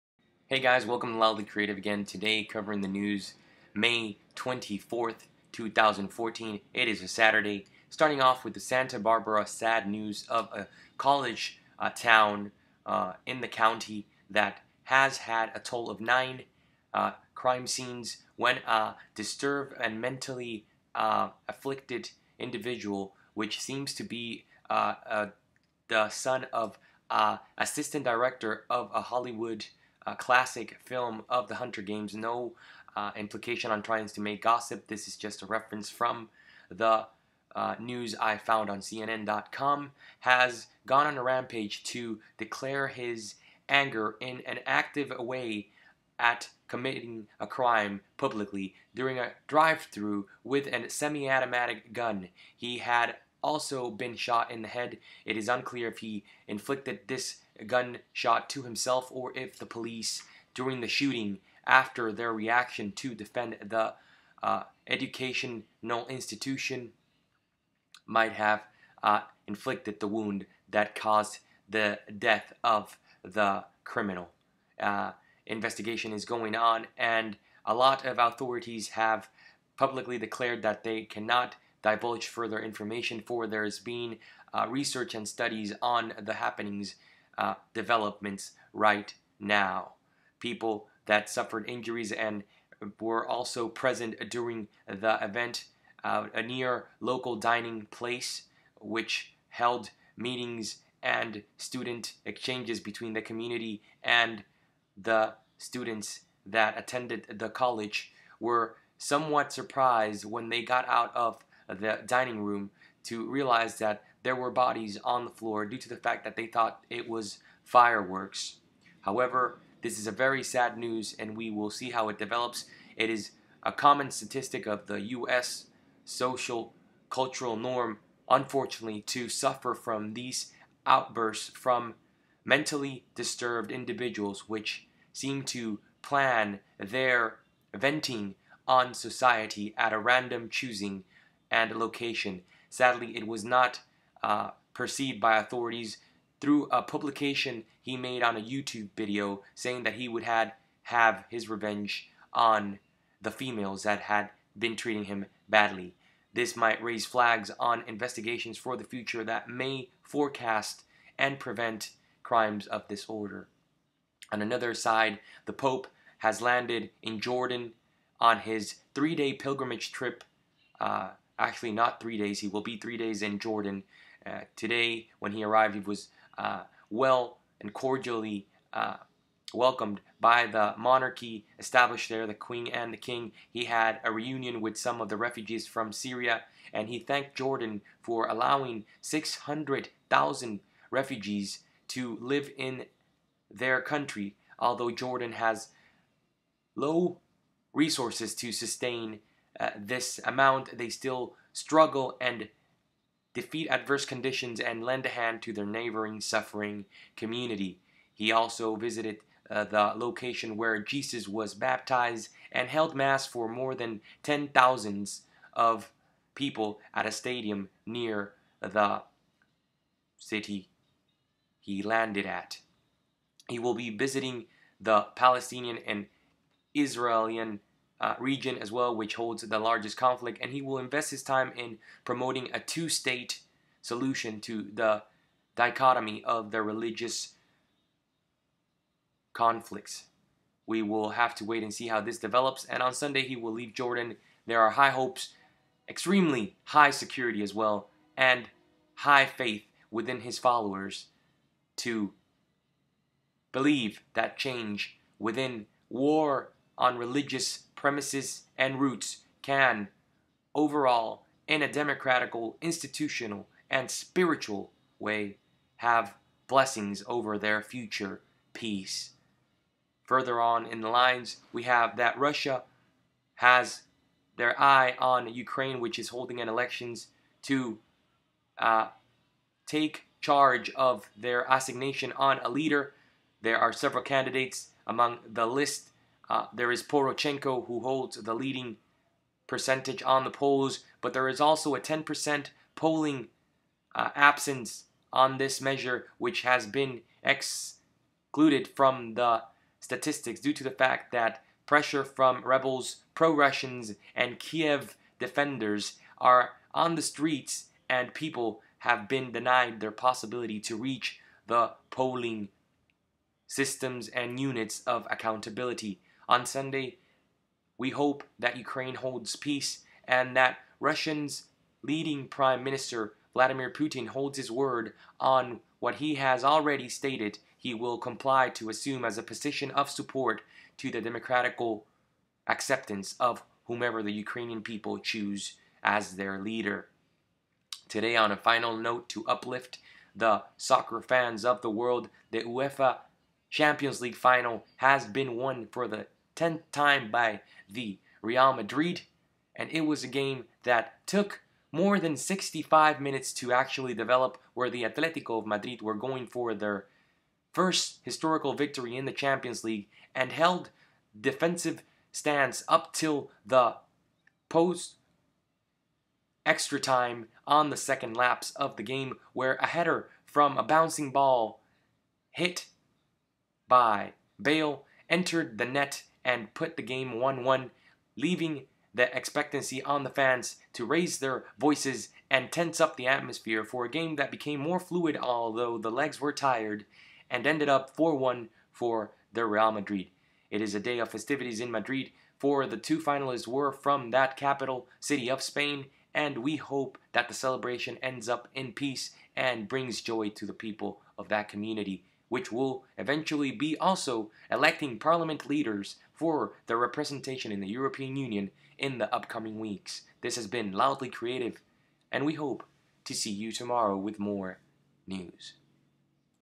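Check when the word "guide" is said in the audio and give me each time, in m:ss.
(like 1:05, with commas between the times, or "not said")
not said.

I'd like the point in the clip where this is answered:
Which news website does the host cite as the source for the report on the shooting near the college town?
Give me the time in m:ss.
0:38.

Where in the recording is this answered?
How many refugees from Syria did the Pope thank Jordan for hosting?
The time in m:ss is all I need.
3:09.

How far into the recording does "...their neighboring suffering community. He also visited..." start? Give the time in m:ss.
3:25.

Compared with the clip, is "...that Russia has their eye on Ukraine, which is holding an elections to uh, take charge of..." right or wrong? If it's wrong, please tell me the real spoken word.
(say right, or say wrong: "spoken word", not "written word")
right.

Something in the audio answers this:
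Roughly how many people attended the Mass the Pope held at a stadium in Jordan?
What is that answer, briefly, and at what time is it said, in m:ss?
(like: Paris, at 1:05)
10,000, at 3:34.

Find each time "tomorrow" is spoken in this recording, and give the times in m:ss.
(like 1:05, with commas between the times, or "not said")
6:53.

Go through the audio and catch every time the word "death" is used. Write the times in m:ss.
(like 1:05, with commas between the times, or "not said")
1:12.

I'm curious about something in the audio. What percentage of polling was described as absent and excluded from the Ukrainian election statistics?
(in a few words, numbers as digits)
10%.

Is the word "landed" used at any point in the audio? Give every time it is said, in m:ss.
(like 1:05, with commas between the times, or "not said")
2:46, 3:41.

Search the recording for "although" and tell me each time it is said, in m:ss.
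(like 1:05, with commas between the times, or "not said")
3:14, 6:25.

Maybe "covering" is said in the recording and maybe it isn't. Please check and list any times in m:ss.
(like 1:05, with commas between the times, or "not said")
0:02.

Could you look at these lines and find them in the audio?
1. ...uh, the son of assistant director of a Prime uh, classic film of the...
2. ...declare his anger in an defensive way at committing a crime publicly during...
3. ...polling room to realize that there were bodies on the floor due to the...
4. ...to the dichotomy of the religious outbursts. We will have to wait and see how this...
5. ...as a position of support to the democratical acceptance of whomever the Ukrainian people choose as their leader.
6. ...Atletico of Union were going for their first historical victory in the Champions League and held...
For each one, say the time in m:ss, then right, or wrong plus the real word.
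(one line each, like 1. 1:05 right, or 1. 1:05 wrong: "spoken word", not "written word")
1. 0:25 wrong: "Hollywood", not "Prime"
2. 0:42 wrong: "active", not "defensive"
3. 1:52 wrong: "dining", not "polling"
4. 3:54 wrong: "conflicts", not "outbursts"
5. 5:29 right
6. 5:54 wrong: "Madrid", not "Union".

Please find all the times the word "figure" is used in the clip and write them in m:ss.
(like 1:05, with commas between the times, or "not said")
not said.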